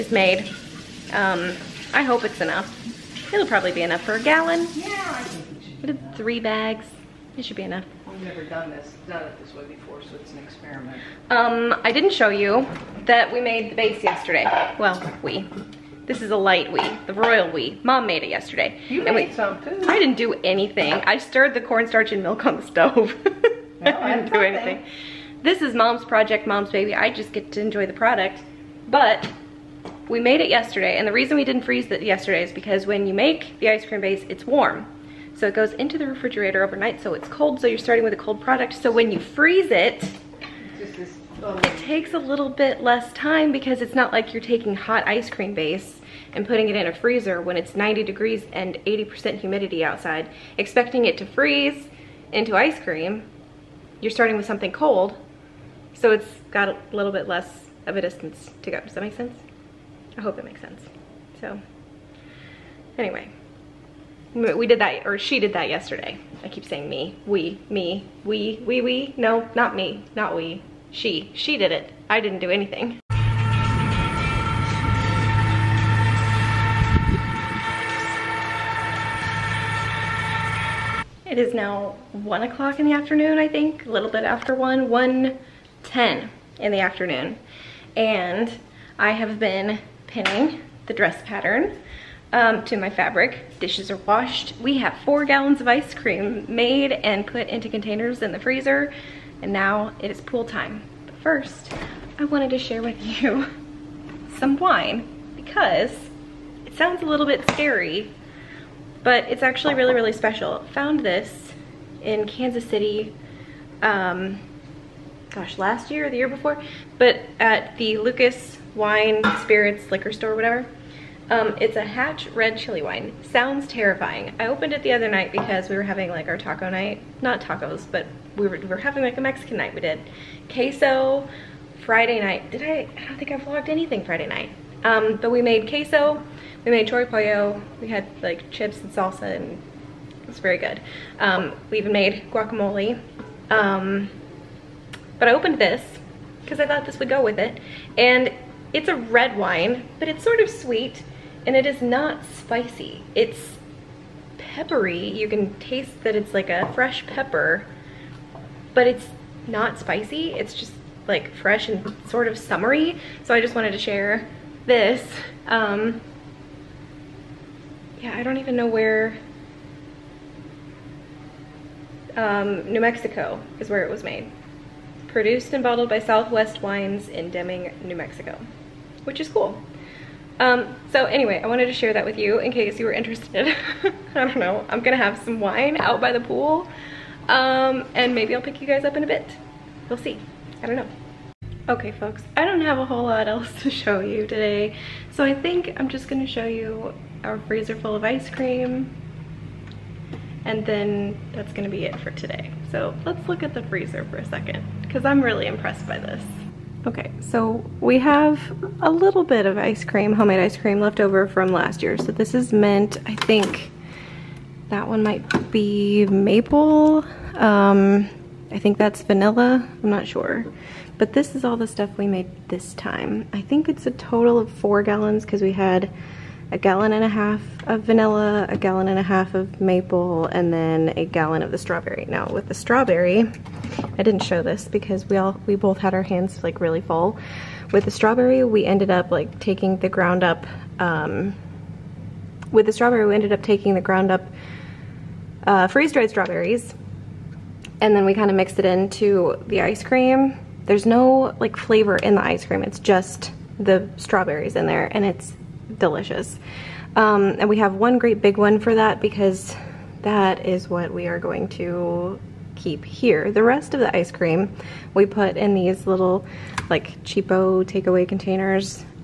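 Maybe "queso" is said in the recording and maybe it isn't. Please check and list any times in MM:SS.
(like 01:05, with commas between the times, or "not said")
02:10, 02:15.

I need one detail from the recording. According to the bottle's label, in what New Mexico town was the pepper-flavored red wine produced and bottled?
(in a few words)
Deming.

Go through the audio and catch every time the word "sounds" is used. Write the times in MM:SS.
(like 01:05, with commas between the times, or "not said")
01:46, 02:03.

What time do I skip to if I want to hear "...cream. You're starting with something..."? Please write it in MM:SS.
00:52.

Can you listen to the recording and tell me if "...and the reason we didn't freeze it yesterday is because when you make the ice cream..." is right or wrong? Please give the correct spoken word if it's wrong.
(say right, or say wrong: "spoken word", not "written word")
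right.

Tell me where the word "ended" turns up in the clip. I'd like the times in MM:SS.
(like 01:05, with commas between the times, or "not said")
03:58, 04:03.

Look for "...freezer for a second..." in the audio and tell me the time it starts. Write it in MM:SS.
03:23.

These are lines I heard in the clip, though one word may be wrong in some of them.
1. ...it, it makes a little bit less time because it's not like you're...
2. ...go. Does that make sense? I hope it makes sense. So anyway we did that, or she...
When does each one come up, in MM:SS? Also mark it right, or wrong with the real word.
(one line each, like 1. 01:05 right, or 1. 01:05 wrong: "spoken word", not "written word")
1. 00:39 wrong: "takes", not "makes"
2. 00:58 right.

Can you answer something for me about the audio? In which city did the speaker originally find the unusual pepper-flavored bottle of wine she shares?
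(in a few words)
Kansas City.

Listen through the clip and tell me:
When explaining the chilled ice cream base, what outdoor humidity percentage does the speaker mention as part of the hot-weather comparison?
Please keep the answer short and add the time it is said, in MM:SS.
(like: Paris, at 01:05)
80%, at 00:48.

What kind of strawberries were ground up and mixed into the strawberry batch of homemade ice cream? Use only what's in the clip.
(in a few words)
freeze dried.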